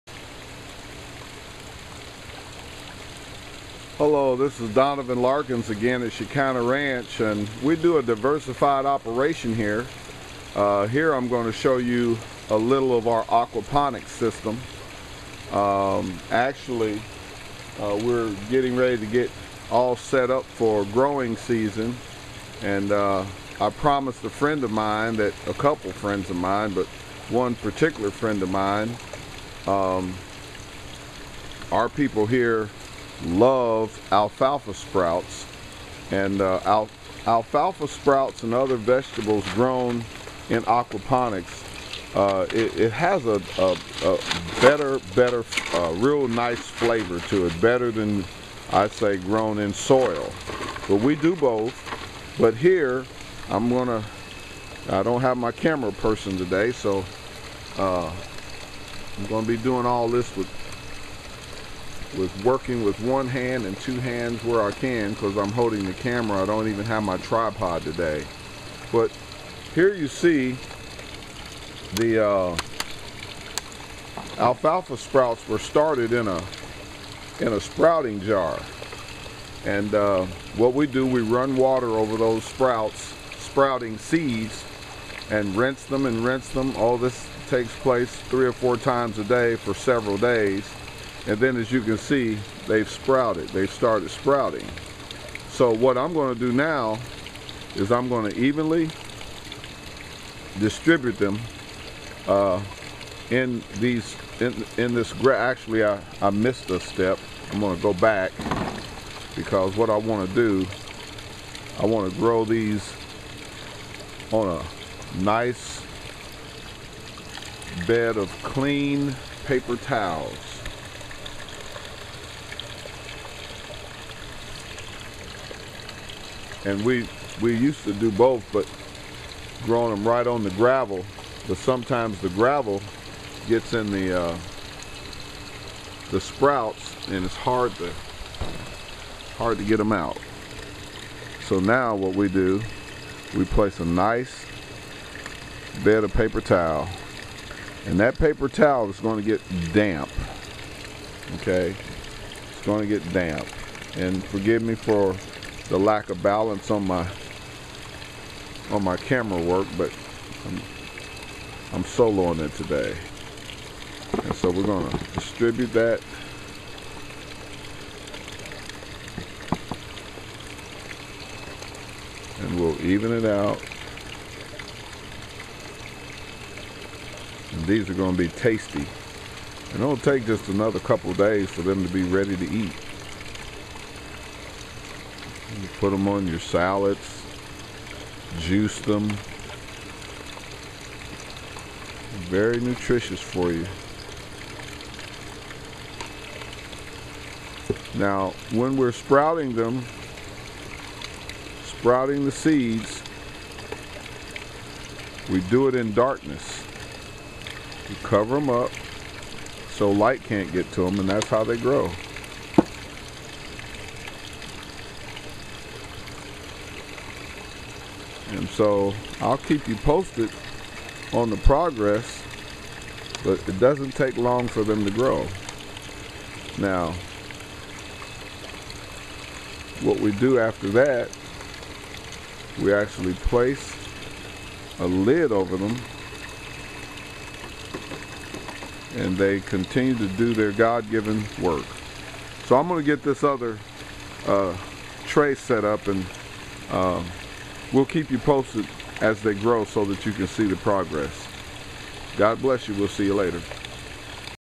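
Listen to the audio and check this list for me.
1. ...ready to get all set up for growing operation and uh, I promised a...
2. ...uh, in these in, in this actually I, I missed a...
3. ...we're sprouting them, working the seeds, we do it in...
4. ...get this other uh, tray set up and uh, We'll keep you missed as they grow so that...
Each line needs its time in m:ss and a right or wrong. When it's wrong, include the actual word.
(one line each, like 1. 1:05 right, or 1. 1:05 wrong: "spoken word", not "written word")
1. 0:18 wrong: "season", not "operation"
2. 1:42 right
3. 3:18 wrong: "sprouting", not "working"
4. 4:02 wrong: "posted", not "missed".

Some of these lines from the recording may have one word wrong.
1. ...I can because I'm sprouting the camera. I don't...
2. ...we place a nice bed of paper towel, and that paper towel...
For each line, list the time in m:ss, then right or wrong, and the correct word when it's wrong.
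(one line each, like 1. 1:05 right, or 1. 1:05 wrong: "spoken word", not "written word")
1. 1:04 wrong: "holding", not "sprouting"
2. 2:23 right.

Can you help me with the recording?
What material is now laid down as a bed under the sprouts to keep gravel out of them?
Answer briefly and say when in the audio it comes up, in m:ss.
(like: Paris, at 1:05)
paper towels, at 1:59.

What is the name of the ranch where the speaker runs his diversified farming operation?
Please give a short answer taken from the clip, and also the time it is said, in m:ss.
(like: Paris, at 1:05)
Shekinah Ranch, at 0:06.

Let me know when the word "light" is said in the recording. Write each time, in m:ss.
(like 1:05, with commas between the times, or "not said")
3:29.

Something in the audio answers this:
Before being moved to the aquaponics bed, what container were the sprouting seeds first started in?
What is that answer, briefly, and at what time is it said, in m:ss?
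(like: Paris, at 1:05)
sprouting jar, at 1:17.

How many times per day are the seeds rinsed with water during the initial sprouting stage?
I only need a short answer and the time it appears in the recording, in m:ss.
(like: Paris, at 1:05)
3 or 4, at 1:28.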